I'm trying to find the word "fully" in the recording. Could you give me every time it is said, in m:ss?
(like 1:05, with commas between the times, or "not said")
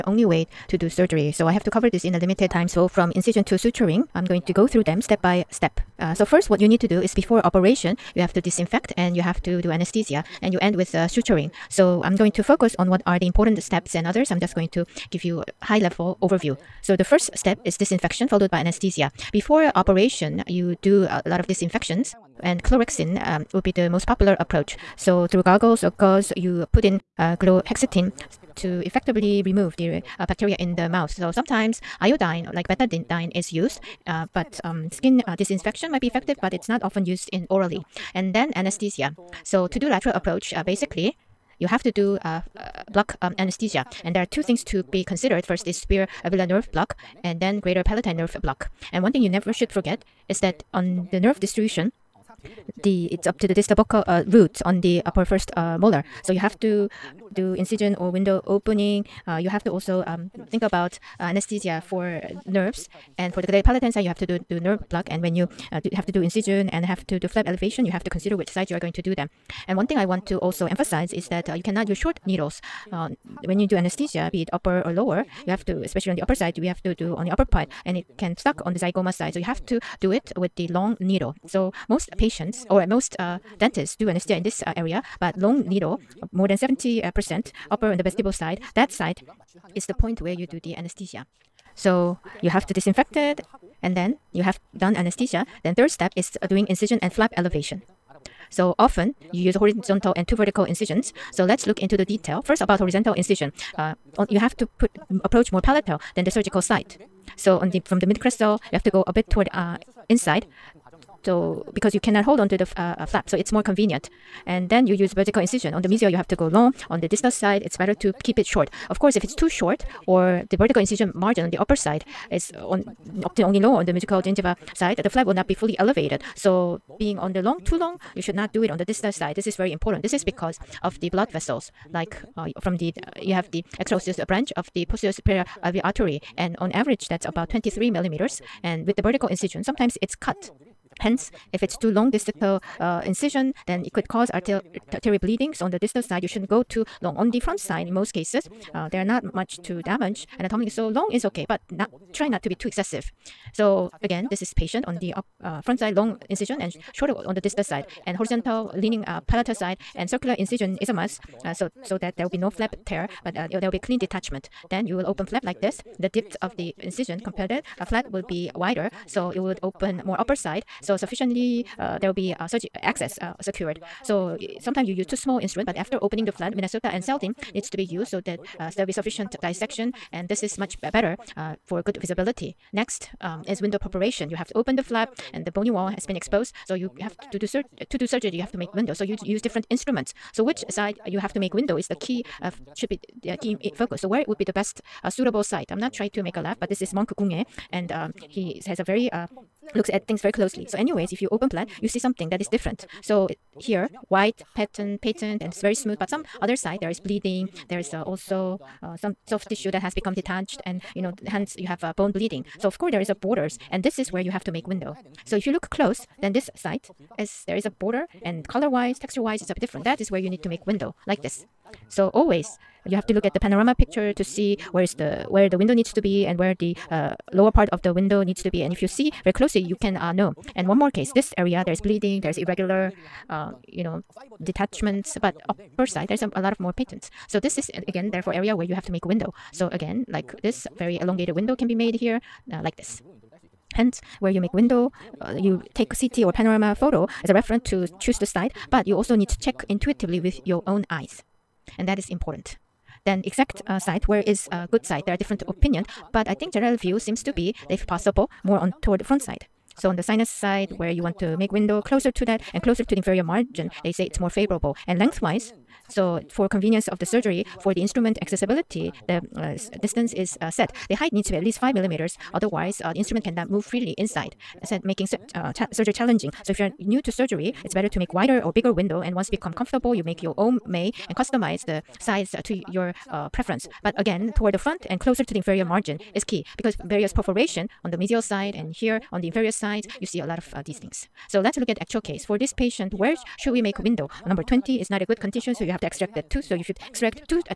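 2:05.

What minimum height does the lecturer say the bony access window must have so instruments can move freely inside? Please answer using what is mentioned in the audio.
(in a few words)
5 millimeters.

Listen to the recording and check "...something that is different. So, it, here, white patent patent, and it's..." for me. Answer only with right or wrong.
right.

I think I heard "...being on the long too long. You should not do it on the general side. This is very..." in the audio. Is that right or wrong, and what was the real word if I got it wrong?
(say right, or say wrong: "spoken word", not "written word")
wrong: "distal", not "general".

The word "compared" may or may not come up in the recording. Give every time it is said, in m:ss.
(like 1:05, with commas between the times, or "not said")
2:47.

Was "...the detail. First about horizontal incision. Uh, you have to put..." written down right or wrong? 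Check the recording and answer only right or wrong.
right.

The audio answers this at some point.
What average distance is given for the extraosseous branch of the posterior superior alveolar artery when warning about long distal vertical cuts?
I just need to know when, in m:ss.
2:17.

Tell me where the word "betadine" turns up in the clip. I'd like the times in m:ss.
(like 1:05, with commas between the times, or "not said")
0:32.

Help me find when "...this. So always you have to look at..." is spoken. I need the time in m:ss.
3:41.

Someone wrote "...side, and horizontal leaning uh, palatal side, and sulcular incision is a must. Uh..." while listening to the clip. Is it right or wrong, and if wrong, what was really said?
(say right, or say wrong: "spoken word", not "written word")
right.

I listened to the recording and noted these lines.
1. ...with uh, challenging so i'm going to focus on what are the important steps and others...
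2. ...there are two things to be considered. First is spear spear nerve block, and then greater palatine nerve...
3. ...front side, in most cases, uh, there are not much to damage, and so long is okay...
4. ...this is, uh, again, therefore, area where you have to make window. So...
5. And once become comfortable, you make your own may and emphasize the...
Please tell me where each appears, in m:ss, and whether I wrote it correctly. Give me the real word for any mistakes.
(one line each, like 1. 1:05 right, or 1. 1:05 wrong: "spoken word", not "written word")
1. 0:10 wrong: "suturing", not "challenging"
2. 0:44 wrong: "alveolar", not "spear"
3. 2:27 right
4. 3:57 right
5. 4:39 wrong: "customize", not "emphasize".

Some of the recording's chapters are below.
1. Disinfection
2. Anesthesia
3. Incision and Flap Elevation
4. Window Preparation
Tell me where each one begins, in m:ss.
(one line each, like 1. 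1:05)
1. 0:19
2. 0:36
3. 1:31
4. 3:01.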